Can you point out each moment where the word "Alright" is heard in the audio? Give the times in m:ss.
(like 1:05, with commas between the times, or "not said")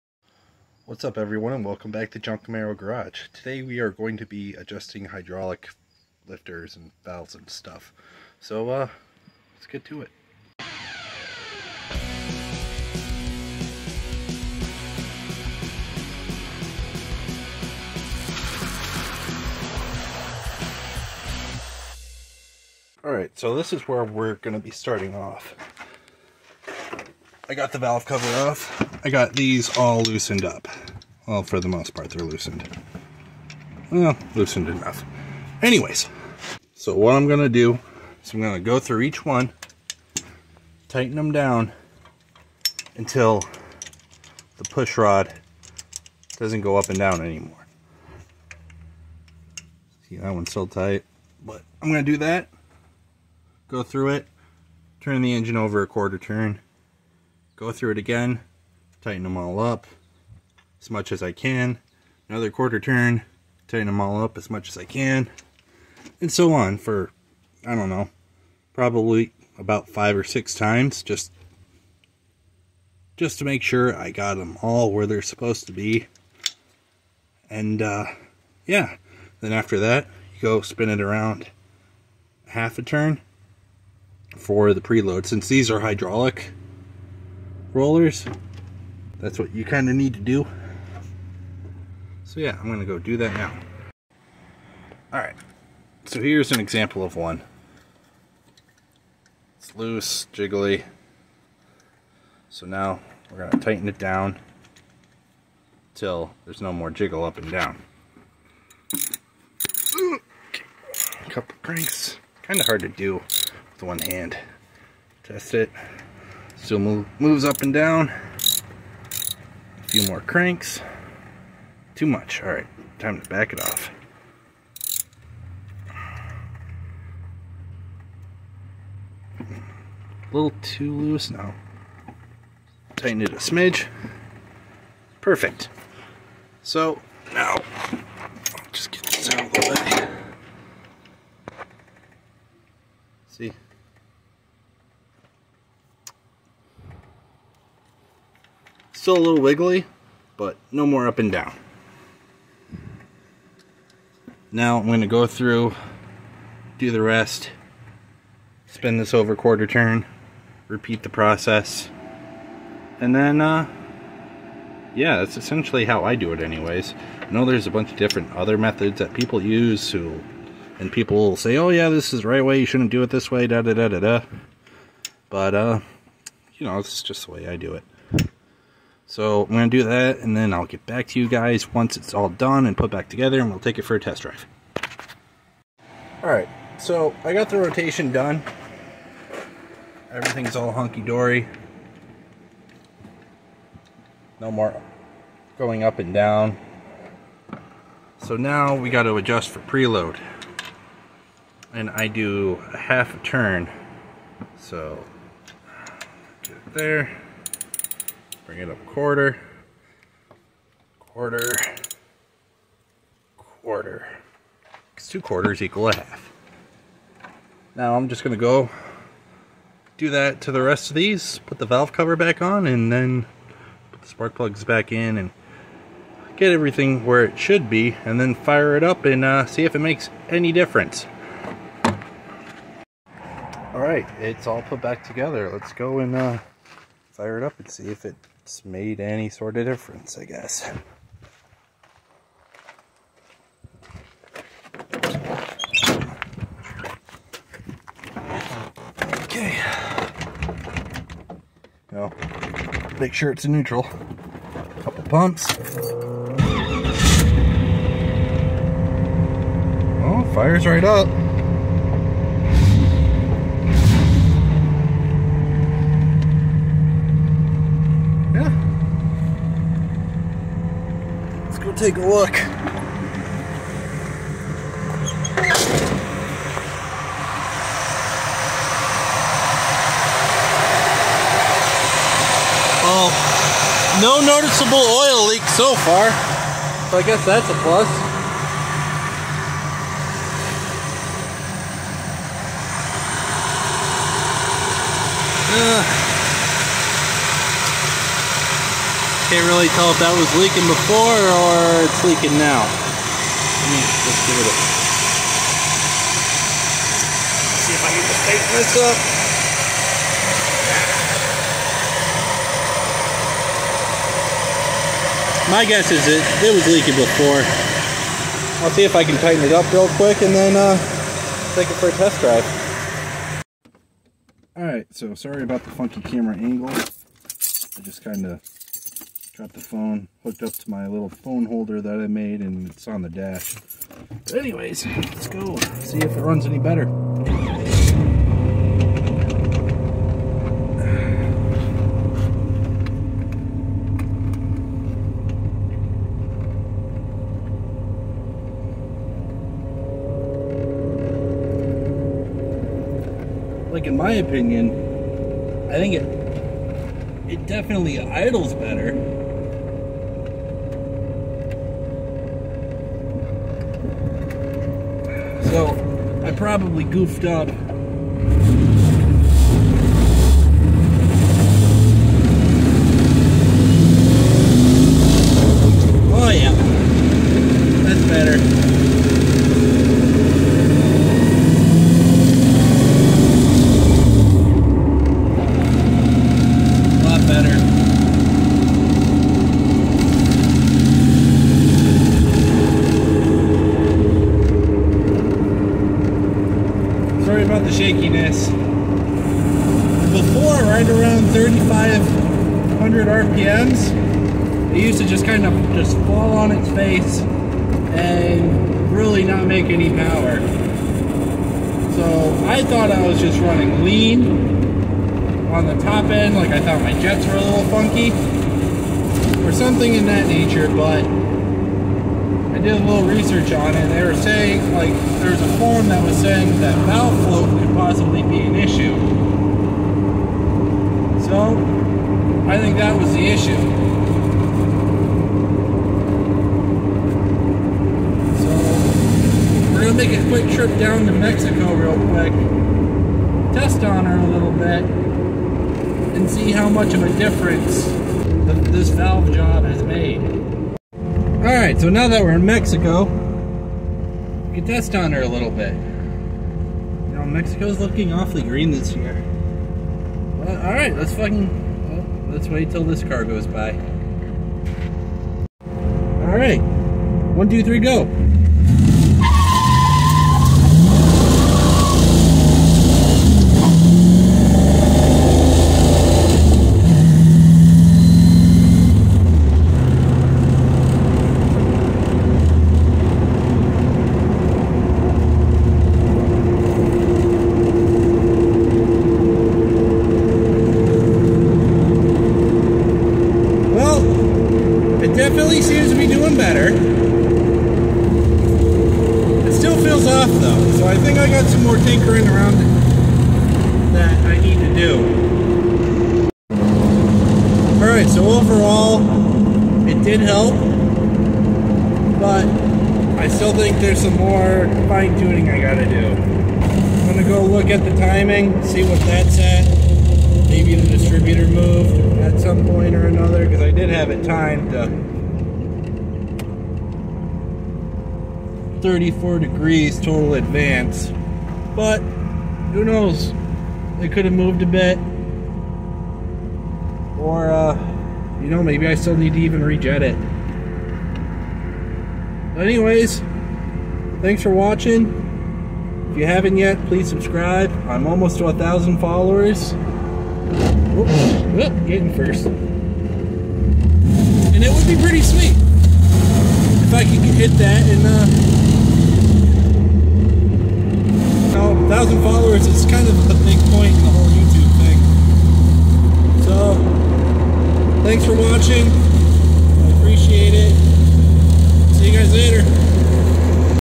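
0:23, 3:06, 5:24, 8:27.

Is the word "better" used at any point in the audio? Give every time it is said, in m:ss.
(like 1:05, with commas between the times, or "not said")
5:36, 5:58, 6:18.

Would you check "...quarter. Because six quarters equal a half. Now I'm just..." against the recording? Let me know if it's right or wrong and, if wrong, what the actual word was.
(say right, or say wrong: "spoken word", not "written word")
wrong: "two", not "six".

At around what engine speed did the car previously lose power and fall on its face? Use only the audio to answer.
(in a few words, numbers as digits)
3,500 RPM.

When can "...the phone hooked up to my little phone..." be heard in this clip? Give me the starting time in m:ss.
5:29.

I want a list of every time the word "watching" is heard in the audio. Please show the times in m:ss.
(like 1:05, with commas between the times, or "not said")
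9:04, 9:28.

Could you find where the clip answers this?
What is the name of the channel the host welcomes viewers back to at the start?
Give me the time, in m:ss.
0:02.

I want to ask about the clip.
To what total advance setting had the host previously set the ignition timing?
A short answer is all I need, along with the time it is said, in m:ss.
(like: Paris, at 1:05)
34 degrees, at 8:48.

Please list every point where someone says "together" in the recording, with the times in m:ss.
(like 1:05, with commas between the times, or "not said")
3:03, 3:55.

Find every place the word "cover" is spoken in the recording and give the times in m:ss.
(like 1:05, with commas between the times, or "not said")
0:28, 3:41.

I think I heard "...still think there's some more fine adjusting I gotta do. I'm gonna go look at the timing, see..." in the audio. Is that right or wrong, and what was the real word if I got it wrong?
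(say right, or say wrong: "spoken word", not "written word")
wrong: "tuning", not "adjusting".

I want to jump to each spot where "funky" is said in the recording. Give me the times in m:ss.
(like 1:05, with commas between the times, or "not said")
5:25, 6:57.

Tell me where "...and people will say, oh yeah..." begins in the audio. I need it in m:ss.
2:50.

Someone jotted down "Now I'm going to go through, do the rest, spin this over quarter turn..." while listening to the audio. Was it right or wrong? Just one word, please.
right.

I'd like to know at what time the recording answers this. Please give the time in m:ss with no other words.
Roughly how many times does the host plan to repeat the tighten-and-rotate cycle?
1:09.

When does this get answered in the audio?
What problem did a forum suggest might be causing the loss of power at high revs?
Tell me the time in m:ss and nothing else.
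7:06.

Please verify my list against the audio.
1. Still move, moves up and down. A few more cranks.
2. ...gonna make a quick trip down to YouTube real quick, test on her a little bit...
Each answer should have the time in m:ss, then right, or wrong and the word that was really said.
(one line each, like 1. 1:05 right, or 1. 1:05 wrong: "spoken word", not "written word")
1. 1:56 right
2. 7:19 wrong: "Mexico", not "YouTube".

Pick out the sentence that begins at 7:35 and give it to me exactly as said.
You know, Mexico's looking awfully green this year.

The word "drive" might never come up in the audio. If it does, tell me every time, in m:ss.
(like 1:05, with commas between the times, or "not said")
3:04, 5:22.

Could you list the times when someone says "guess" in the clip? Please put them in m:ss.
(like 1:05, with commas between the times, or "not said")
4:00, 4:47, 5:15.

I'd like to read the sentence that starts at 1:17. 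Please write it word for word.
And uh, yeah, then after that, you go spin it around half a turn for the preload.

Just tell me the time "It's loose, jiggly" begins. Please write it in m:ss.
1:39.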